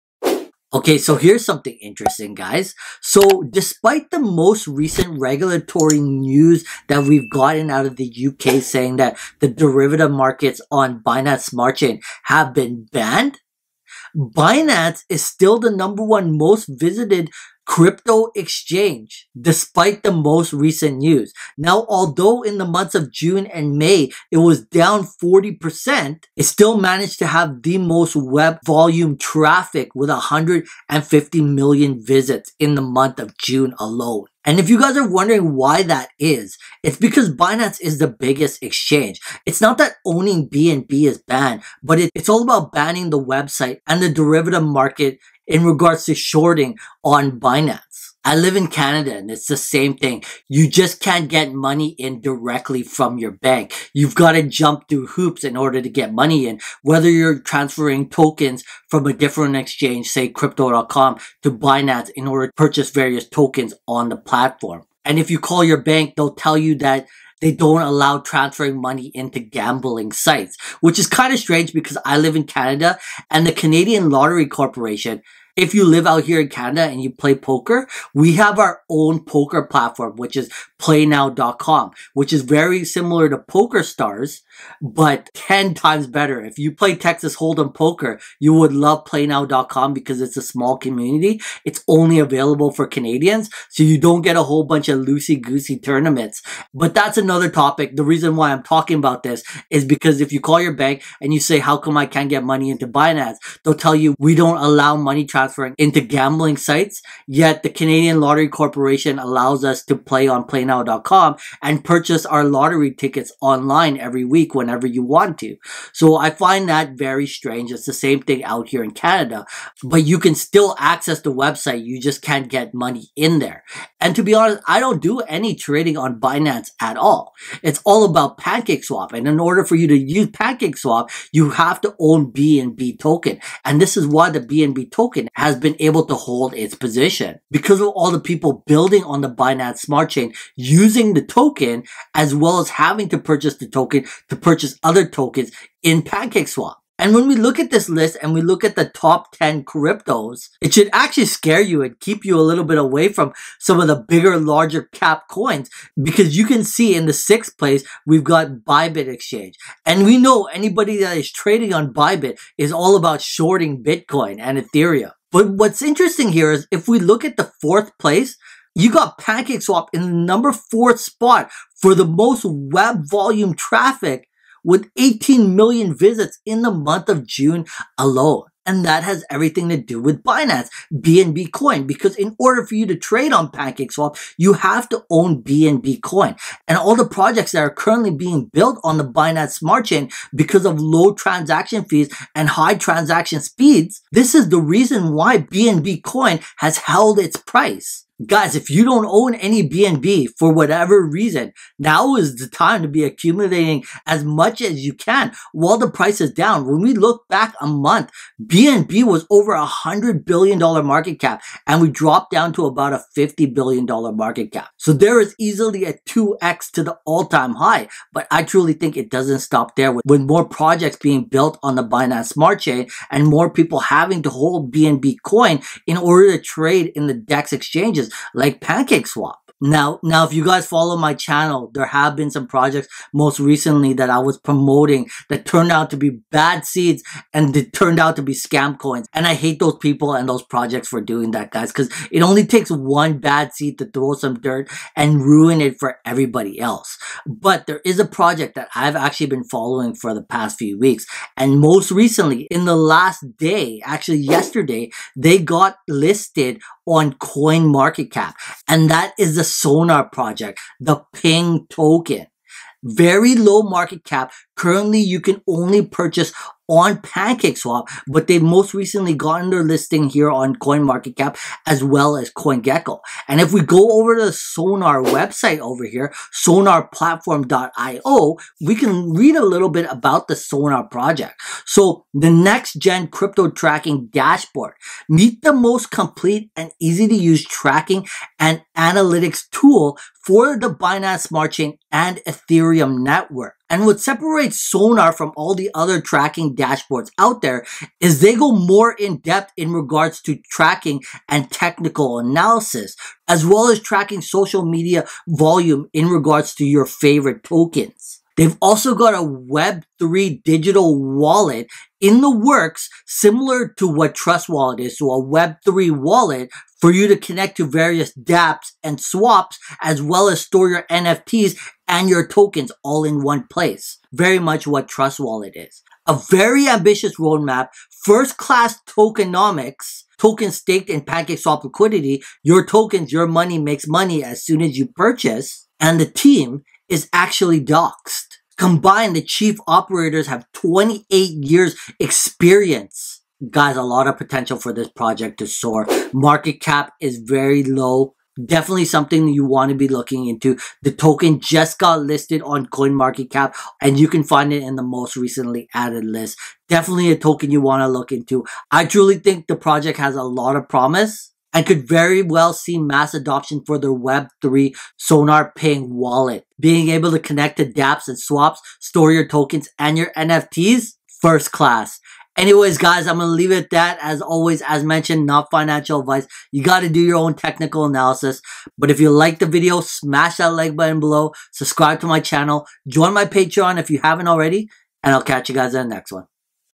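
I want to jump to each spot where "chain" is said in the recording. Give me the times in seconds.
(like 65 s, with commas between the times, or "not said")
11 s, 140 s, 189 s, 222 s, 291 s.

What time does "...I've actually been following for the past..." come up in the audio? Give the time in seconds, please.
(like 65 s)
248 s.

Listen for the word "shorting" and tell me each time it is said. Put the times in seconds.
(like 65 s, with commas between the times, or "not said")
46 s, 163 s.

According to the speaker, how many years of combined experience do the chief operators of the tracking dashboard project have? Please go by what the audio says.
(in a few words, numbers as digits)
28 years.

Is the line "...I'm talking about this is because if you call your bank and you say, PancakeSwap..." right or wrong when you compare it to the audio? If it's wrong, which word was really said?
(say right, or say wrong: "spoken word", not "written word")
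wrong: "How", not "PancakeSwap".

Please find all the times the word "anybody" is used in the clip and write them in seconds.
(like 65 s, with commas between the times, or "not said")
160 s.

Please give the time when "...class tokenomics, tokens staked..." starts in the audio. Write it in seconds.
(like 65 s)
328 s.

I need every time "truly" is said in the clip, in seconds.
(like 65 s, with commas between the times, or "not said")
218 s, 358 s.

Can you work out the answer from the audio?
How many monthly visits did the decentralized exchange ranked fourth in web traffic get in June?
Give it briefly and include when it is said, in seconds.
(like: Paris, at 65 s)
18 million, at 174 s.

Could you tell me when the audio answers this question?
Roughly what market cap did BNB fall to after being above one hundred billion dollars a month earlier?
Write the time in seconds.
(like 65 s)
213 s.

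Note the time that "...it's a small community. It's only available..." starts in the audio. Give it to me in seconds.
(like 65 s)
90 s.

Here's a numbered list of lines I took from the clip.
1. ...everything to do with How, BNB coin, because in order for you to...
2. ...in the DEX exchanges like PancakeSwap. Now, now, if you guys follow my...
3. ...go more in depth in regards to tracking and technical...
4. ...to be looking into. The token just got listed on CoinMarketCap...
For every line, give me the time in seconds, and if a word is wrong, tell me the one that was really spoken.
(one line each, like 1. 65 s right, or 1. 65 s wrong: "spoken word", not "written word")
1. 179 s wrong: "Binance", not "How"
2. 226 s right
3. 298 s right
4. 349 s right.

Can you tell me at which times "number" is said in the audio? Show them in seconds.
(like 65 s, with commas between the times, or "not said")
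15 s, 170 s.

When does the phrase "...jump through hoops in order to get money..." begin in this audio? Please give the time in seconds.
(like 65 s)
54 s.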